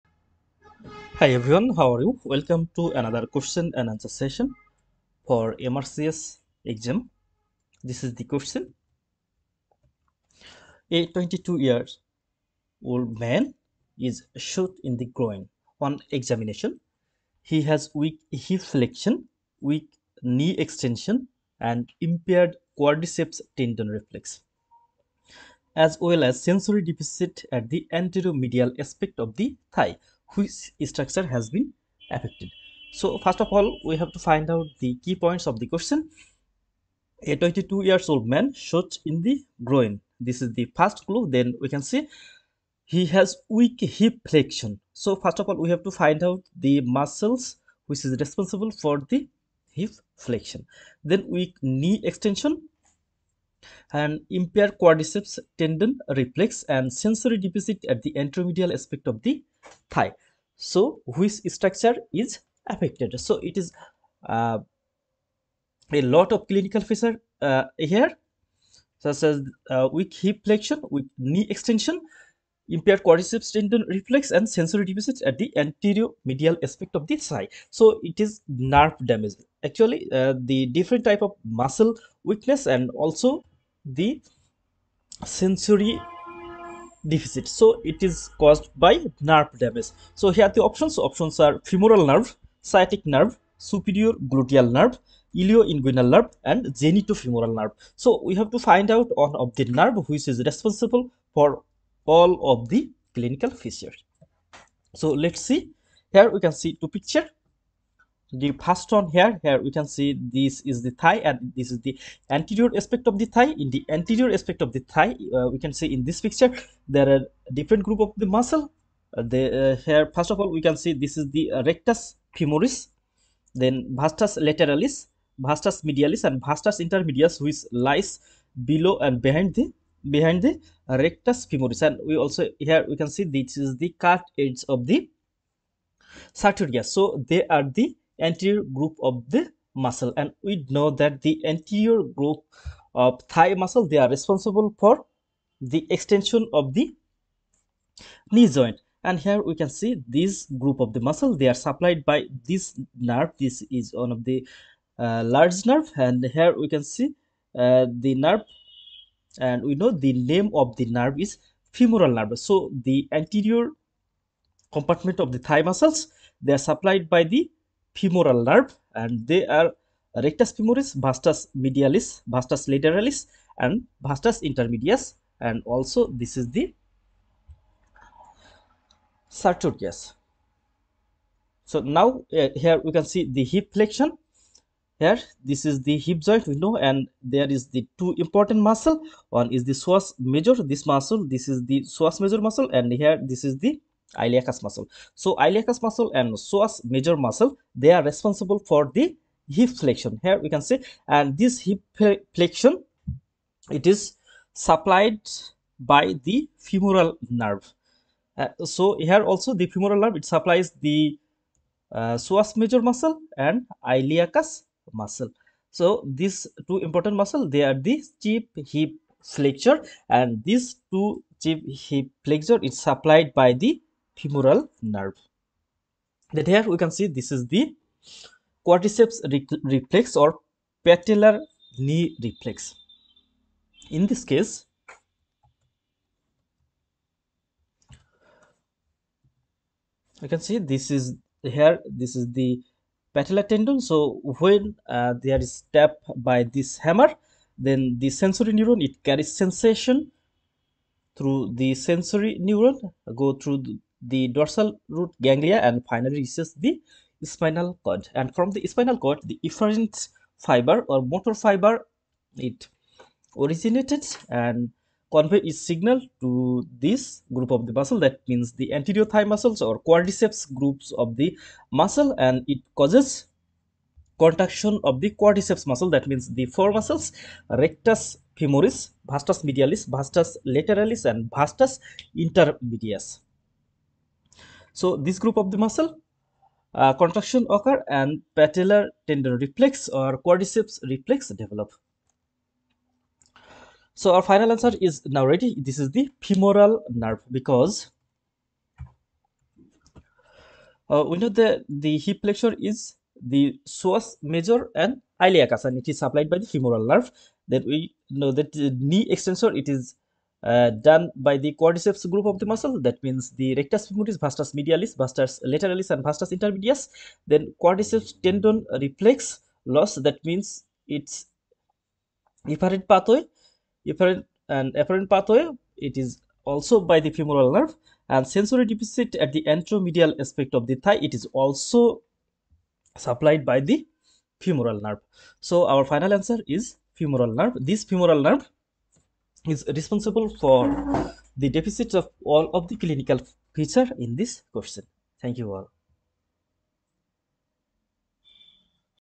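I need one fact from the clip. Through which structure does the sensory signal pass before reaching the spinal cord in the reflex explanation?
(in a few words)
Dorsal root ganglia.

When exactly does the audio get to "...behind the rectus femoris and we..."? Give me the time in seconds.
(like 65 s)
130 s.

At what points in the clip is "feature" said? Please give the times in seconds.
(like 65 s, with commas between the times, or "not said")
66 s, 103 s, 343 s.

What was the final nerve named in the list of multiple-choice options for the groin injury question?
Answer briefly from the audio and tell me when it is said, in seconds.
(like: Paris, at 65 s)
Genitofemoral nerve, at 96 s.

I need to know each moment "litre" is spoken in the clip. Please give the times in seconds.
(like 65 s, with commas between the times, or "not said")
not said.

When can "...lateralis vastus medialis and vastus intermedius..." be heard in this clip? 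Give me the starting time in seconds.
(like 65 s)
124 s.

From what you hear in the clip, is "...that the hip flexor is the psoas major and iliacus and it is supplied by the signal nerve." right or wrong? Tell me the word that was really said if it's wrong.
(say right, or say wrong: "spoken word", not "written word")
wrong: "femoral", not "signal".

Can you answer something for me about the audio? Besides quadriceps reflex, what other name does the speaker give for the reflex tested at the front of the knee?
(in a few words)
Patellar knee reflex.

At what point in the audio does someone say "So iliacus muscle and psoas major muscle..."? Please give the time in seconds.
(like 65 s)
195 s.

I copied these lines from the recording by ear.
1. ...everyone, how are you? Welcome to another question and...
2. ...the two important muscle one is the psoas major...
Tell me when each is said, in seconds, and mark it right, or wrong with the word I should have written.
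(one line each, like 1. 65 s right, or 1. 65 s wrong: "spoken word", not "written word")
1. 1 s right
2. 187 s right.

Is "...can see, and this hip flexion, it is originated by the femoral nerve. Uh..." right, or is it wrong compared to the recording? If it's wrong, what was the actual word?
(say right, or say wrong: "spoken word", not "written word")
wrong: "supplied", not "originated".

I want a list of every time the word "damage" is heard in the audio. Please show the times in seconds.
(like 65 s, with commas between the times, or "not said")
79 s, 89 s.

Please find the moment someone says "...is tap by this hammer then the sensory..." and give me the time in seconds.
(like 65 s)
245 s.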